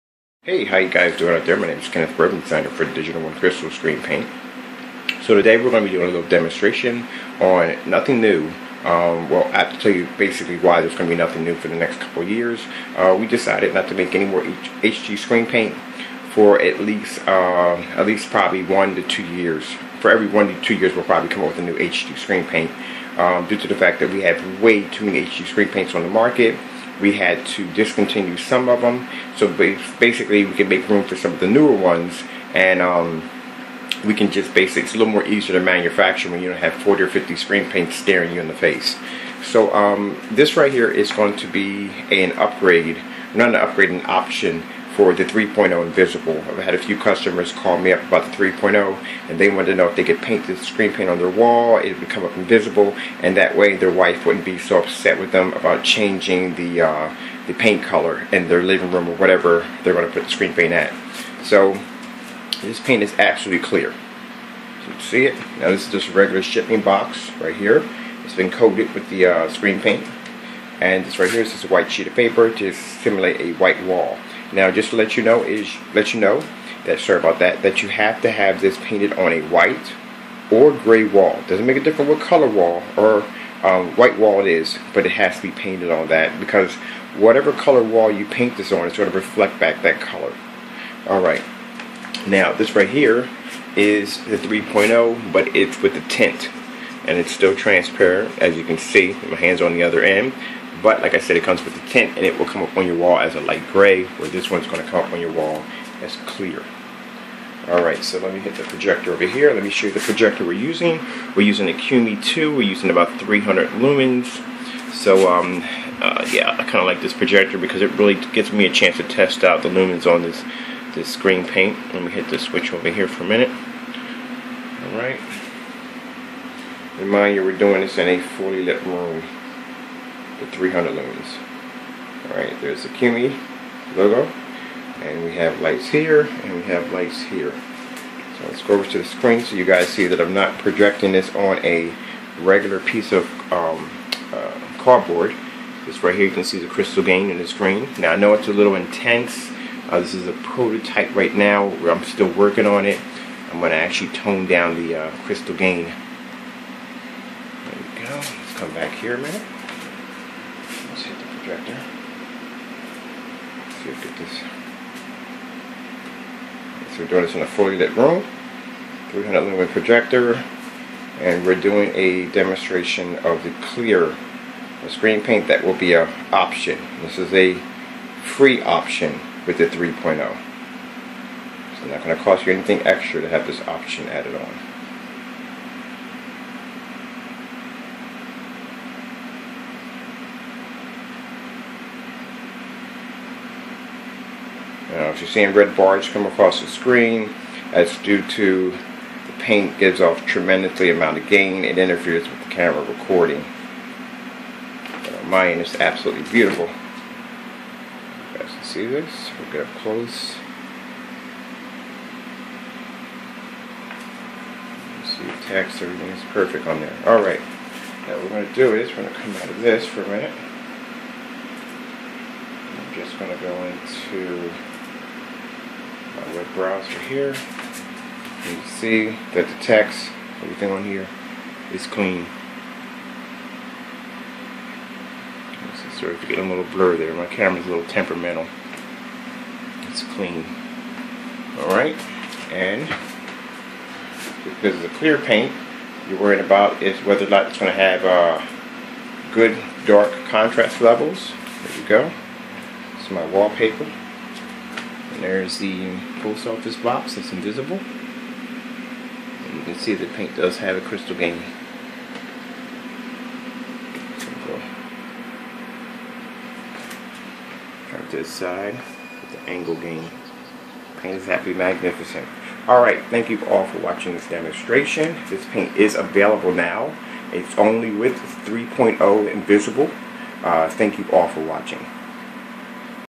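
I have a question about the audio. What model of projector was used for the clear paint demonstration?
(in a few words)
Qumi 2.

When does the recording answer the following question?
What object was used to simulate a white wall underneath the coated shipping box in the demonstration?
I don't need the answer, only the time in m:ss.
1:11.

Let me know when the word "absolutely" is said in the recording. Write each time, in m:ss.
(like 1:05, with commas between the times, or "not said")
1:03, 3:25.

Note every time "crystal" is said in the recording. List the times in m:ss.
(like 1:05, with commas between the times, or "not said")
0:03, 2:26, 2:35, 4:20.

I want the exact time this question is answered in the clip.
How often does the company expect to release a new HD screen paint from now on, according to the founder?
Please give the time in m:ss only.
0:20.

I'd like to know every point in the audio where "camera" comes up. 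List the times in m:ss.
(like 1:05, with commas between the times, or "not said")
3:22, 3:57.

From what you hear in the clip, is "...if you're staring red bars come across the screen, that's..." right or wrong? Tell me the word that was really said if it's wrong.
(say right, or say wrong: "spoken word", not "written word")
wrong: "seeing", not "staring".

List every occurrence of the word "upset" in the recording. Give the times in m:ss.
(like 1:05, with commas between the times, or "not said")
0:54.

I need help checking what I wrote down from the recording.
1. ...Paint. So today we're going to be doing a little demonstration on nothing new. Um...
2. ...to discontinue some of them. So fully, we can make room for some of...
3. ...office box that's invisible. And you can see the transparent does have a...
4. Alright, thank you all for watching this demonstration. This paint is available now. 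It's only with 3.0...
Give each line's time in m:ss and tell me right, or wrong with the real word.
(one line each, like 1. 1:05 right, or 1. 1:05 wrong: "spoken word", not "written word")
1. 0:04 right
2. 0:27 wrong: "basically", not "fully"
3. 4:16 wrong: "paint", not "transparent"
4. 4:32 right.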